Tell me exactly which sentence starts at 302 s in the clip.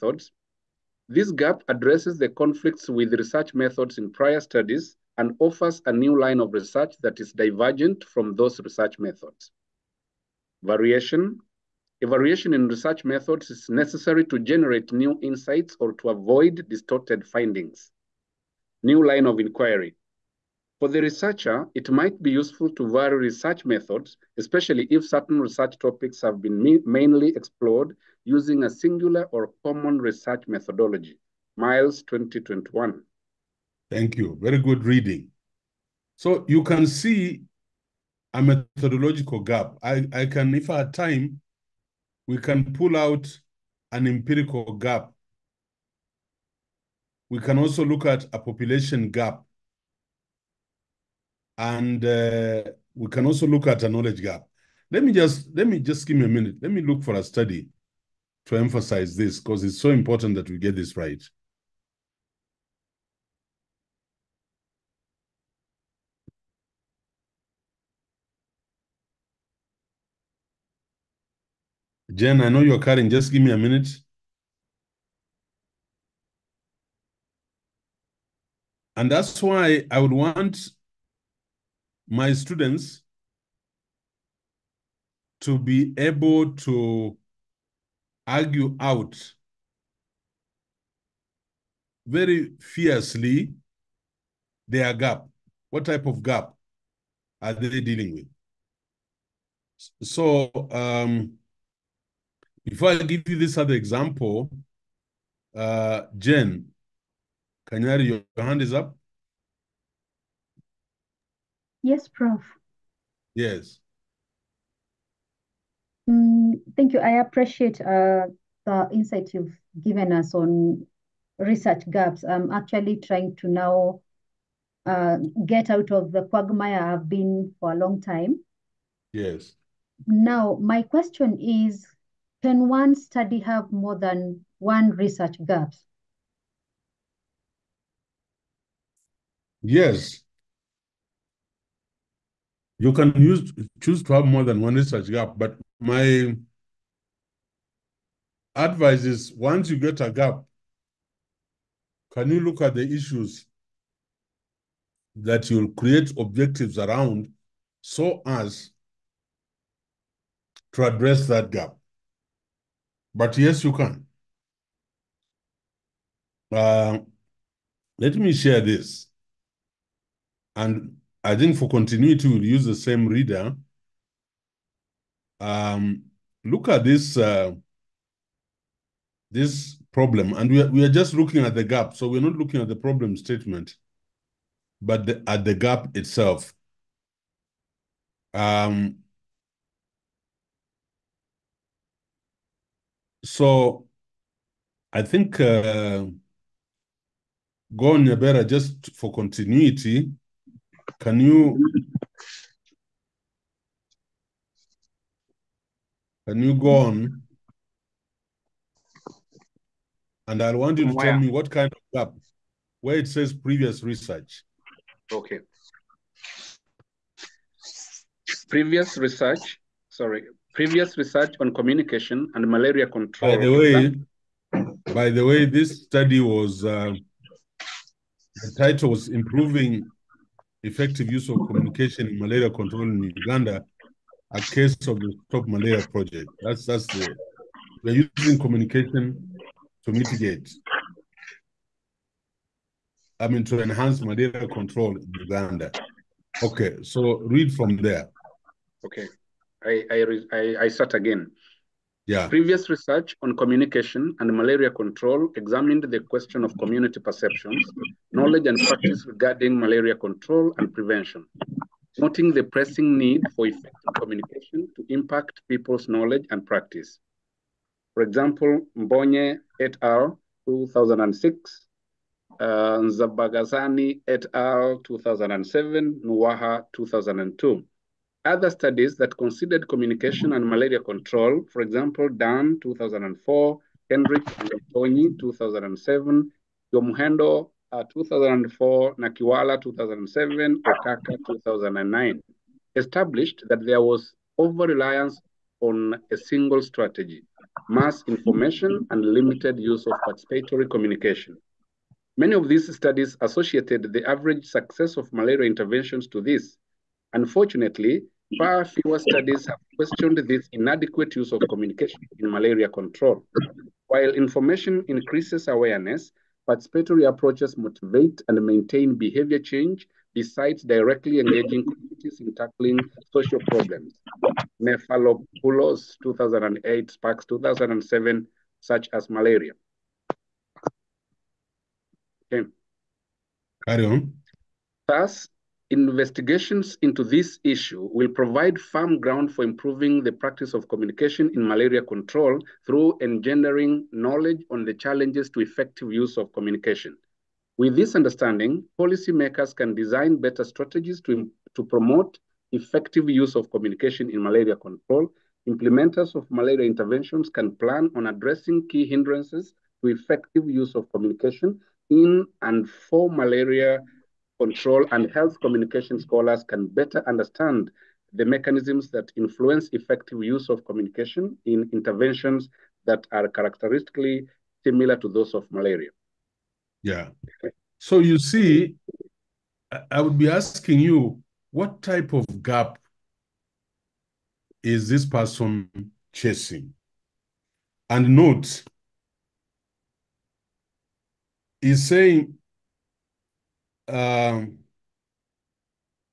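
Many of these studies associated the average success of malaria interventions to this.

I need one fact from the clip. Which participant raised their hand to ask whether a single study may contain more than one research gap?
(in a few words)
Kanyari.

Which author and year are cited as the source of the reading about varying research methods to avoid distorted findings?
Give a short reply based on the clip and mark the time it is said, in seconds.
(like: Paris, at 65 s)
Miles 2021, at 31 s.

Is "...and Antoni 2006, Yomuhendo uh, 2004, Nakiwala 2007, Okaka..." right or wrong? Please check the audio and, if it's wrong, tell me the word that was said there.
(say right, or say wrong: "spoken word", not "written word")
wrong: "2007", not "2006".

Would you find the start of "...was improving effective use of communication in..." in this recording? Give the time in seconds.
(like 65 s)
228 s.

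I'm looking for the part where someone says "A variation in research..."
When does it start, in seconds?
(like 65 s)
12 s.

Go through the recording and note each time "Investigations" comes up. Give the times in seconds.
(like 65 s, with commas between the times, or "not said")
335 s.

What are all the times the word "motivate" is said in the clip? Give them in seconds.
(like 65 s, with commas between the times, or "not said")
317 s.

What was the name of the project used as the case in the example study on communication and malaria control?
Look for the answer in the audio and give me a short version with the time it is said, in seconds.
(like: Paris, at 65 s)
Stop Malaria Project, at 235 s.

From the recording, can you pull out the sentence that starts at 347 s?
With this understanding, policymakers can design better strategies to, to promote effective use of communication in malaria control.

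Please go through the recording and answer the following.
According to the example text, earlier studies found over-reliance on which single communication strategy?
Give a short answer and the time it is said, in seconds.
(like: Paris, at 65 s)
mass information, at 297 s.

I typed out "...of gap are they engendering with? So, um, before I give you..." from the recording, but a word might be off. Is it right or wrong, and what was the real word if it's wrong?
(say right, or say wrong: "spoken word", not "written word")
wrong: "dealing", not "engendering".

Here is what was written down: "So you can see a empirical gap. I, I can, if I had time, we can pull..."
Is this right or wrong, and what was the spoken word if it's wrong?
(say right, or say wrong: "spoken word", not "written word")
wrong: "methodological", not "empirical".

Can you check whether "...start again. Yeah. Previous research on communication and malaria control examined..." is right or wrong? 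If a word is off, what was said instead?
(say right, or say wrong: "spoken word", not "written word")
right.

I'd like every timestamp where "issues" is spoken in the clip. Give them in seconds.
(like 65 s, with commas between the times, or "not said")
152 s, 337 s.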